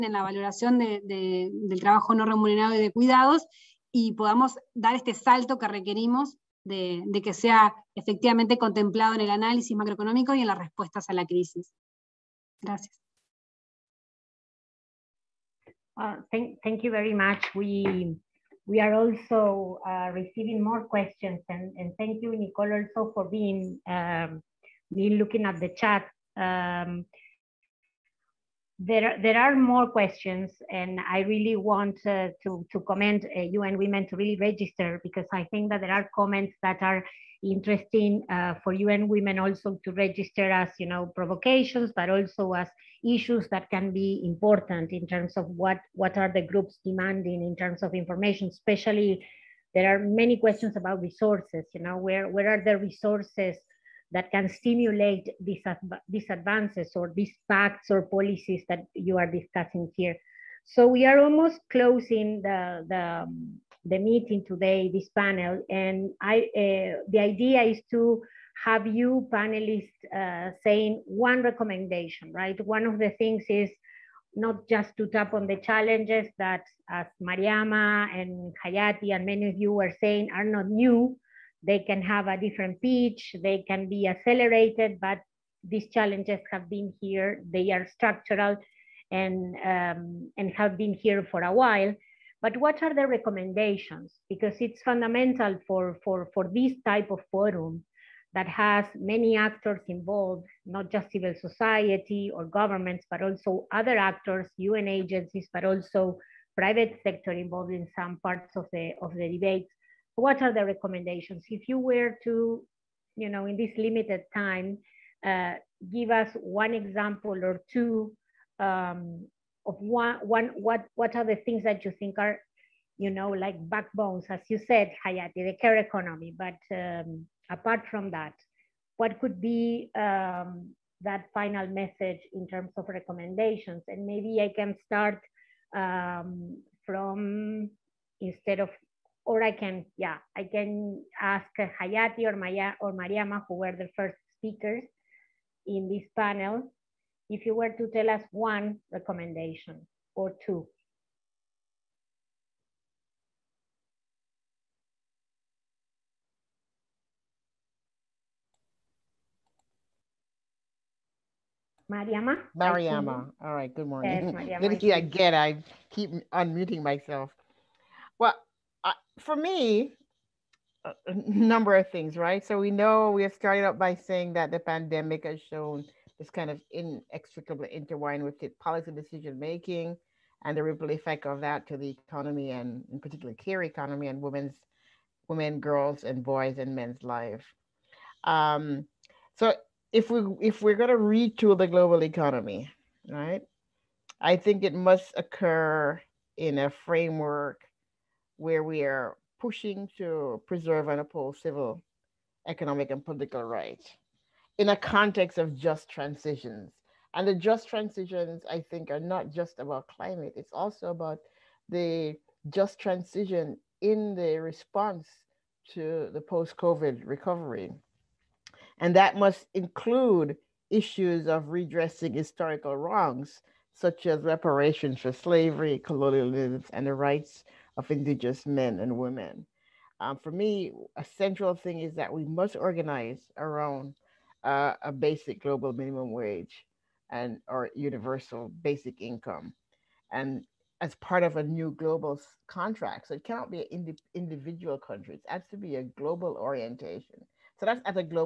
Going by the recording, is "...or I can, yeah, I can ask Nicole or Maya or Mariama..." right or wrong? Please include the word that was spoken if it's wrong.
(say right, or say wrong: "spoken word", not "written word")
wrong: "Jayati", not "Nicole".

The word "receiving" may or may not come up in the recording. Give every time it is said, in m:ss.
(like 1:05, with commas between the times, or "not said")
0:20.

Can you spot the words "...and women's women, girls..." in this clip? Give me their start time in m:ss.
3:04.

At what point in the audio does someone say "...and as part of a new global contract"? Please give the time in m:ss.
4:00.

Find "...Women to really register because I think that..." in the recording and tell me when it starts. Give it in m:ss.
0:33.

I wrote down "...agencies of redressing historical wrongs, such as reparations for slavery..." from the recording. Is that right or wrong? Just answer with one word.
wrong.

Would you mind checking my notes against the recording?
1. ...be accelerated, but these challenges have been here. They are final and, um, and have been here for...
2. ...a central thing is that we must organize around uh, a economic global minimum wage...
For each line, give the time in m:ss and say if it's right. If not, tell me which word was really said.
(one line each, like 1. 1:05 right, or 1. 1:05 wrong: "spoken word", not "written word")
1. 1:23 wrong: "structural", not "final"
2. 3:50 wrong: "basic", not "economic".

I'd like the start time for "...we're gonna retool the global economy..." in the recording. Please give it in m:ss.
3:10.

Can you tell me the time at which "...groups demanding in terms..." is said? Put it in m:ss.
0:46.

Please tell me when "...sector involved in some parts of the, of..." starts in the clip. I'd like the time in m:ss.
1:47.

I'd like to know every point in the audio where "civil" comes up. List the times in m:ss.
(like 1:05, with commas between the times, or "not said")
1:41, 3:21.